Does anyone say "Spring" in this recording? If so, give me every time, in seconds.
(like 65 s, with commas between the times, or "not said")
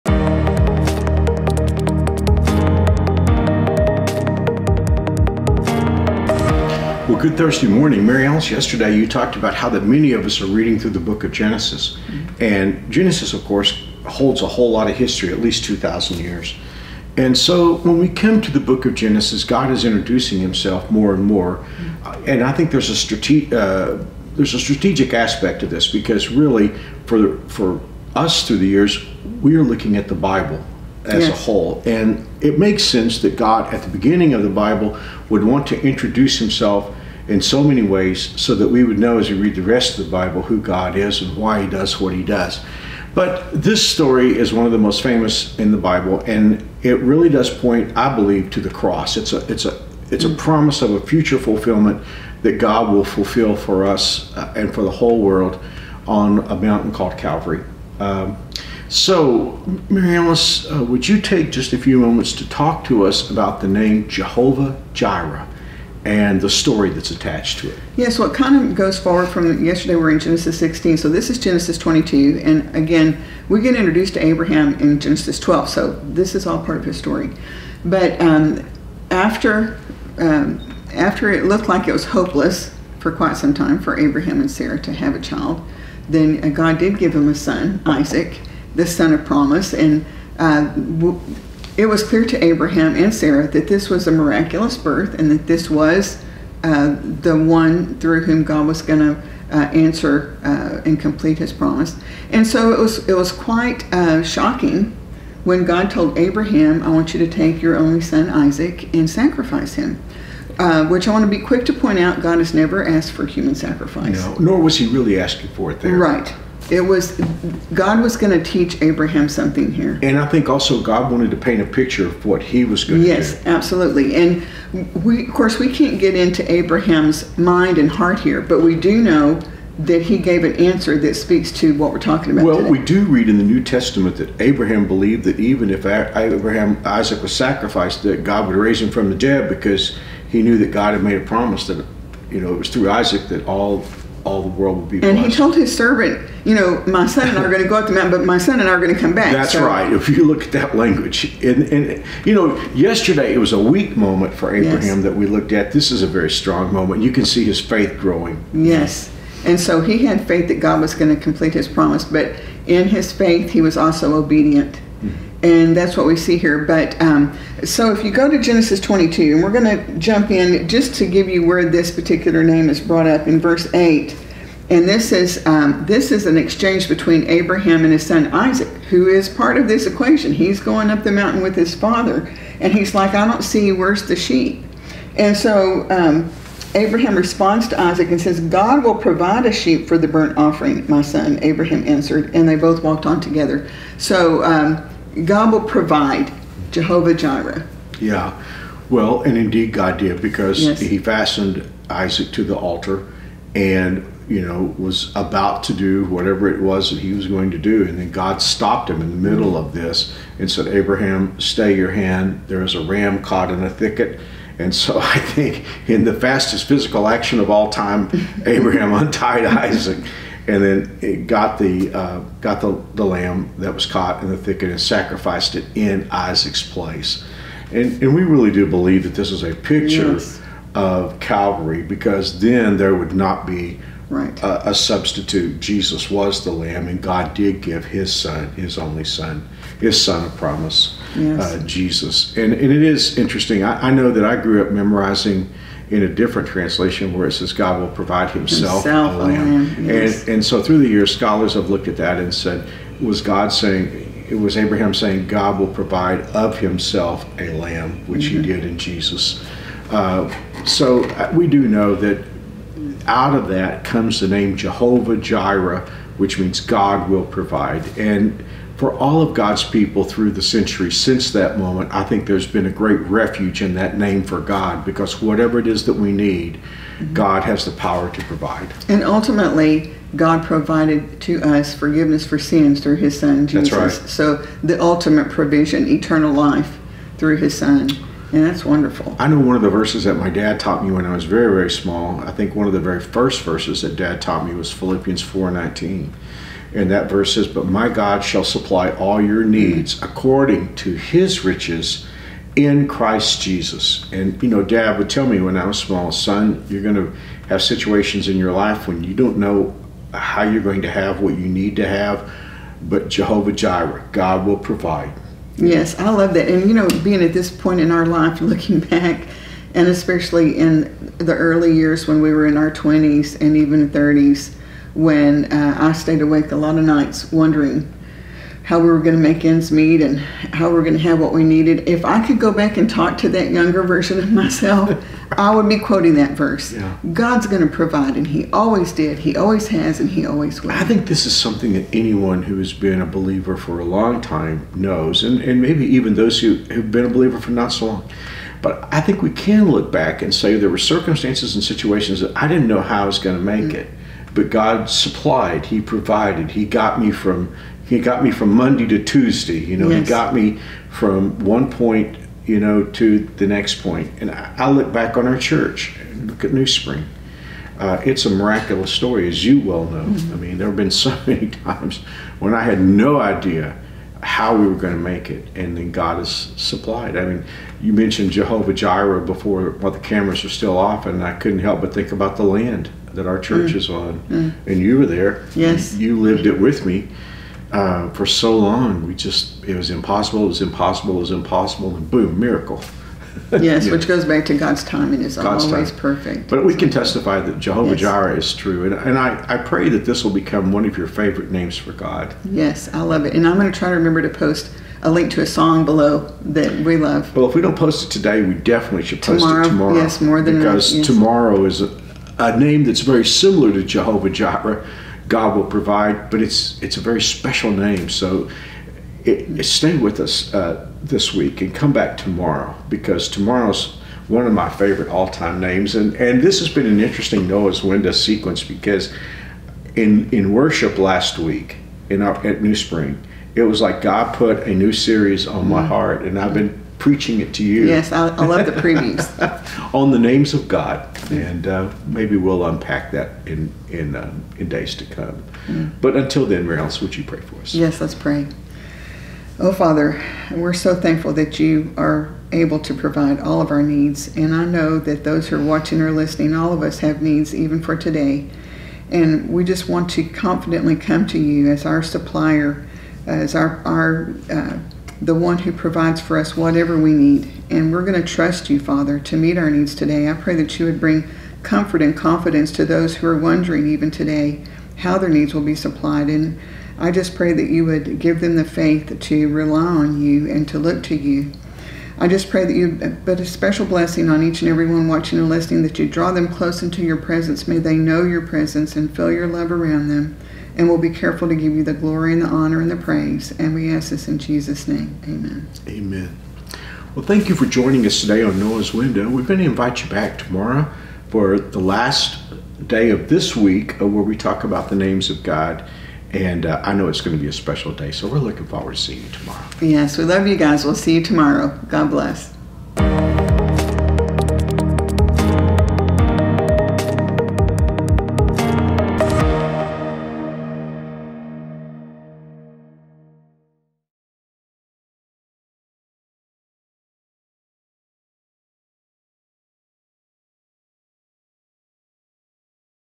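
366 s, 432 s.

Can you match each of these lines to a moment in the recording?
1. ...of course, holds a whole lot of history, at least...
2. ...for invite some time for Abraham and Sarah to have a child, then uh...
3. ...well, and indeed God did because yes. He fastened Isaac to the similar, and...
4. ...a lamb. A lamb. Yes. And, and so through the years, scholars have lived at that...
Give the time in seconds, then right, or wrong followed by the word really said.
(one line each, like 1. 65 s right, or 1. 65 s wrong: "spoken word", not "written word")
1. 13 s right
2. 82 s wrong: "quite", not "invite"
3. 198 s wrong: "altar", not "similar"
4. 249 s wrong: "looked", not "lived".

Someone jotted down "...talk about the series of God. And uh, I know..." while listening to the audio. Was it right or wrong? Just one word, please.
wrong.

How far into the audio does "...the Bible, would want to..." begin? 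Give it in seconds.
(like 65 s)
34 s.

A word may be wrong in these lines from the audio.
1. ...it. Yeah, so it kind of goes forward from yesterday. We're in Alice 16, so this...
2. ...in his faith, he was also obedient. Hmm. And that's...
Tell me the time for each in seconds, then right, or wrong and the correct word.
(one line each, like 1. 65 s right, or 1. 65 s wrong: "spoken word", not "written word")
1. 67 s wrong: "Genesis", not "Alice"
2. 162 s right.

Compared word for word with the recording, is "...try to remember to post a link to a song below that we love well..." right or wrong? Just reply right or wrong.
right.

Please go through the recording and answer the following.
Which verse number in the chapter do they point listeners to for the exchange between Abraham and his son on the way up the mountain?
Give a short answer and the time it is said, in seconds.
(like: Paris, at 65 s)
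verse 8, at 173 s.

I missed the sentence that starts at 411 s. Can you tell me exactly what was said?
tomorrow is a, a name that's very similar to jehovah jireh God will provide, but it's it's a very special name.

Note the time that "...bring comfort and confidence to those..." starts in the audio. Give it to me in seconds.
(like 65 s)
470 s.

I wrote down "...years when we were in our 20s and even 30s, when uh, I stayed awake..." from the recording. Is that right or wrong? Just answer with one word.
right.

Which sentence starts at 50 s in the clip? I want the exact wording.
promise of a future fulfillment that God will fulfill for us uh, and for the whole world on a mountain called Calvary.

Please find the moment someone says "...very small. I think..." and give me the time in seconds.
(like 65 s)
291 s.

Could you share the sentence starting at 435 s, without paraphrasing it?
heart, and I've been preaching it to you.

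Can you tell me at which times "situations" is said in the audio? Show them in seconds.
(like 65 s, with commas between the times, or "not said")
307 s, 351 s.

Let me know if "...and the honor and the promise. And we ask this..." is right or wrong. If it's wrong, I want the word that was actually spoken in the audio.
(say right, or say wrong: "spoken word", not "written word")
wrong: "praise", not "promise".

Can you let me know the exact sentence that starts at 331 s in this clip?
If I could go back and talk to that younger version of myself, I would be quoting that verse.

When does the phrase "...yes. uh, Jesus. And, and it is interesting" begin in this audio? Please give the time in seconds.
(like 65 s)
241 s.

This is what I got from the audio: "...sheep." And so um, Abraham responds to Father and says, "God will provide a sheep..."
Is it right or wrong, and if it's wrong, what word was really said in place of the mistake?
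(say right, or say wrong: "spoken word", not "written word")
wrong: "Isaac", not "Father".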